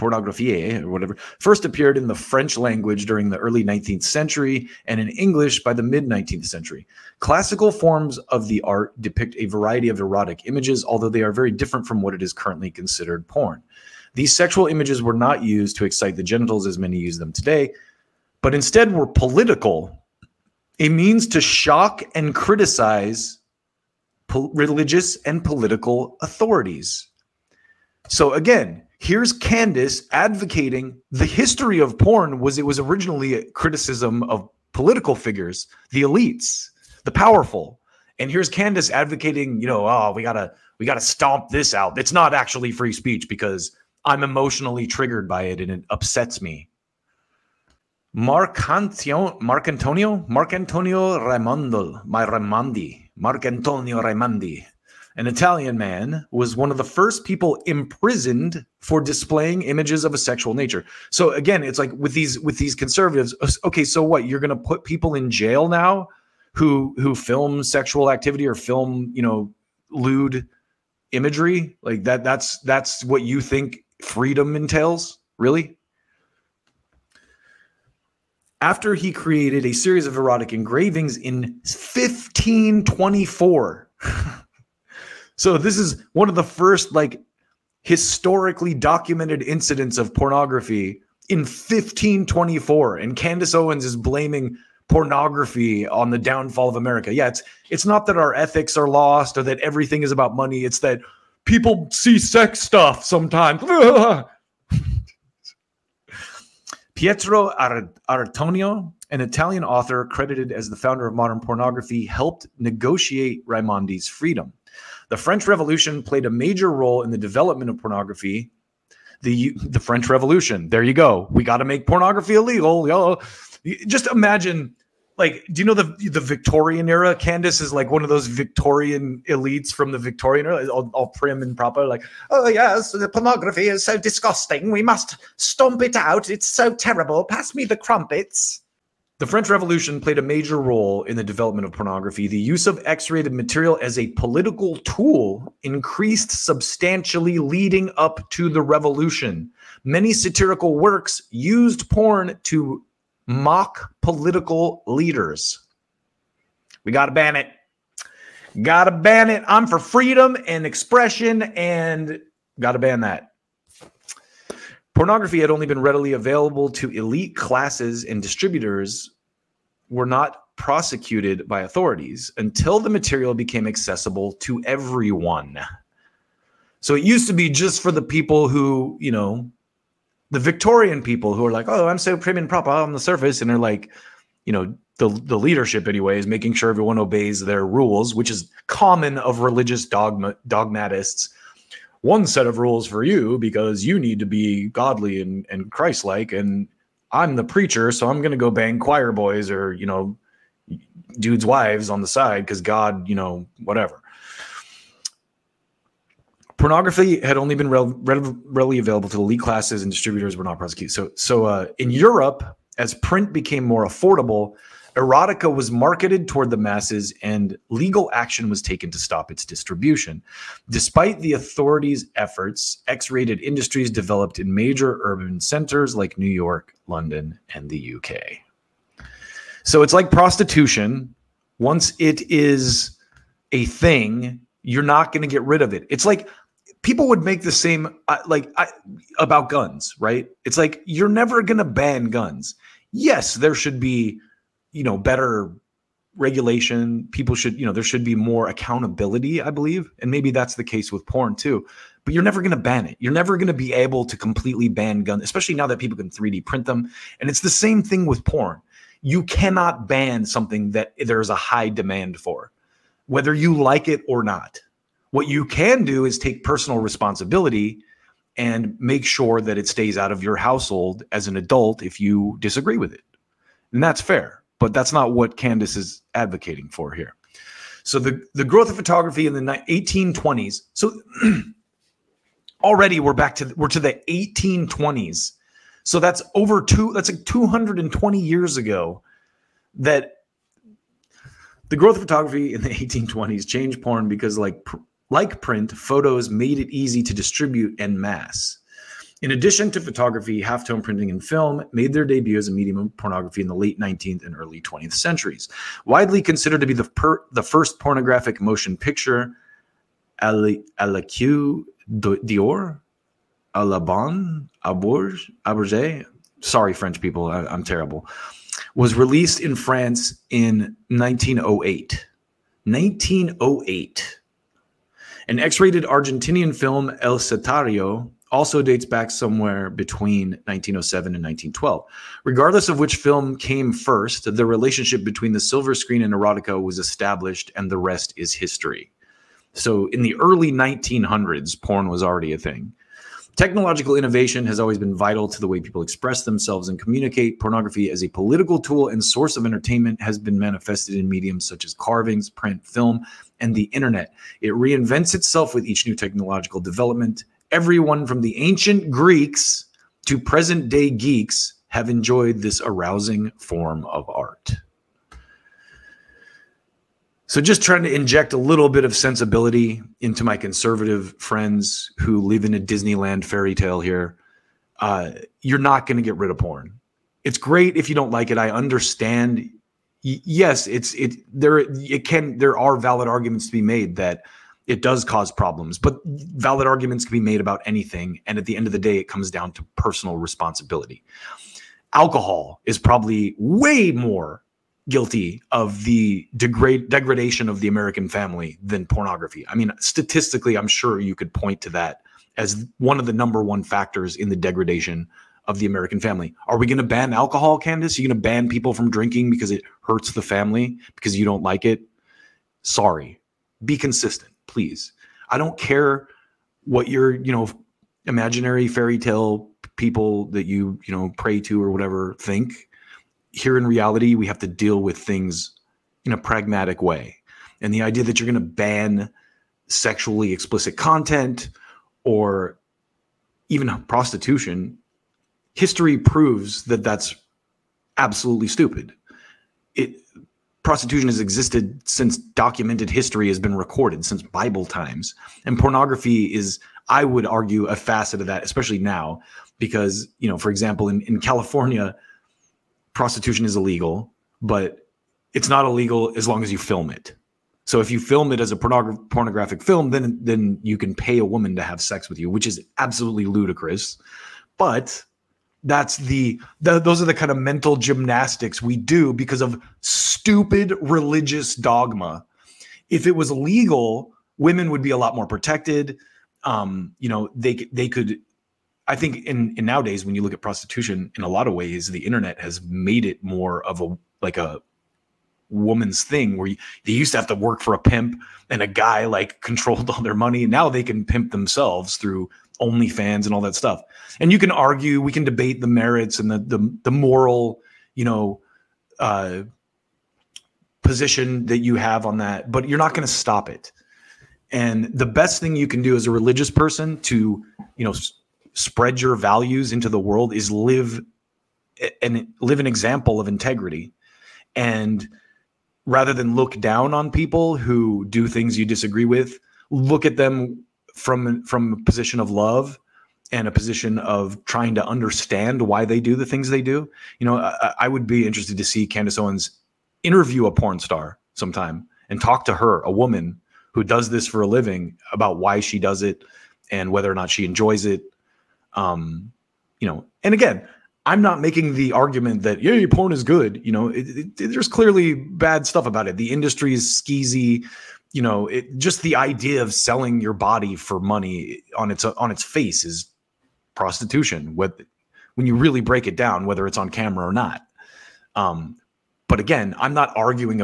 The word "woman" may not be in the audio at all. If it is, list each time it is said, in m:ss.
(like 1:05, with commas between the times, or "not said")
7:41, 8:05, 8:52.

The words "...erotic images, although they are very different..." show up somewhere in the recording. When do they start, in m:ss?
0:09.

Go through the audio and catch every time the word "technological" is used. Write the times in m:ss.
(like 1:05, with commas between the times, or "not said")
5:43, 5:55.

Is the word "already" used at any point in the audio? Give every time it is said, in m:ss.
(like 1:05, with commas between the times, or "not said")
4:42, 5:42.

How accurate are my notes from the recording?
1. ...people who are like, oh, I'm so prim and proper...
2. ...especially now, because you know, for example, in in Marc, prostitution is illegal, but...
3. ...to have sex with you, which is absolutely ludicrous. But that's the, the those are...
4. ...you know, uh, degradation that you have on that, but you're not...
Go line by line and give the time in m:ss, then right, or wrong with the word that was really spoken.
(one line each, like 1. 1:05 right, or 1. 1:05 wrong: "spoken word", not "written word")
1. 3:01 right
2. 7:28 wrong: "California", not "Marc"
3. 7:41 right
4. 8:17 wrong: "position", not "degradation".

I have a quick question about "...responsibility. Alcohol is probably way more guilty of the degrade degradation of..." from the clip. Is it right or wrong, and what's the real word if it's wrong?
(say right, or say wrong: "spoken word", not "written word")
right.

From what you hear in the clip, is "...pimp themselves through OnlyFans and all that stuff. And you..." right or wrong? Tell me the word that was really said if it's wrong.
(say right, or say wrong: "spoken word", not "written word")
right.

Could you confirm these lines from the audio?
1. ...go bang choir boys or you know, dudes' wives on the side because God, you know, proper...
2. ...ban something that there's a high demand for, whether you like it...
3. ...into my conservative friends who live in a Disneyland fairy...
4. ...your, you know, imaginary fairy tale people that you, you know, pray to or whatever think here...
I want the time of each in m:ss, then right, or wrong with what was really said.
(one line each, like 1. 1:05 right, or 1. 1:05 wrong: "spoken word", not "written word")
1. 3:18 wrong: "whatever", not "proper"
2. 4:19 right
3. 6:09 right
4. 6:56 right.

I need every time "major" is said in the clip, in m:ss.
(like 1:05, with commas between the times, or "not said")
1:56, 2:20, 3:44.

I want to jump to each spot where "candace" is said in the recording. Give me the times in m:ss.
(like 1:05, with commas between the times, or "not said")
0:29, 0:38, 1:33, 2:07, 4:35, 6:47, 8:48.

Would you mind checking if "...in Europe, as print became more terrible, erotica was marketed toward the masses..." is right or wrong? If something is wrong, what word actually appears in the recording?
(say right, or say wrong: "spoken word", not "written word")
wrong: "affordable", not "terrible".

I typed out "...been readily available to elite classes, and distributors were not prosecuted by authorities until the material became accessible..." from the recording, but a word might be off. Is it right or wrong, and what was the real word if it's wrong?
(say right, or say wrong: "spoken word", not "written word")
right.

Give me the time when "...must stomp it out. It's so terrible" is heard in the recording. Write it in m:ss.
2:14.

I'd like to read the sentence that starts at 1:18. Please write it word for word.
After he created a series of erotic engravings in 1524.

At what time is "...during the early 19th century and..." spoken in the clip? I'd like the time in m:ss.
0:03.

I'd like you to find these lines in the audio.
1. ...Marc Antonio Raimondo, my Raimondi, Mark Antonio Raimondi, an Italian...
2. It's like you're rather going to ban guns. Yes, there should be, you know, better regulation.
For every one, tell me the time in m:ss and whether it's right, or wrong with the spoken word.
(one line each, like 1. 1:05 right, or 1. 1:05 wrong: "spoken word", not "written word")
1. 0:50 right
2. 4:00 wrong: "never", not "rather".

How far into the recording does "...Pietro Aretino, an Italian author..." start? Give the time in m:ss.
1:46.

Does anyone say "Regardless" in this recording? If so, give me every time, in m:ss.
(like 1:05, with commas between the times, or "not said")
5:32.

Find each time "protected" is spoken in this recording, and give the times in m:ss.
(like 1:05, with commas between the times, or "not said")
7:55.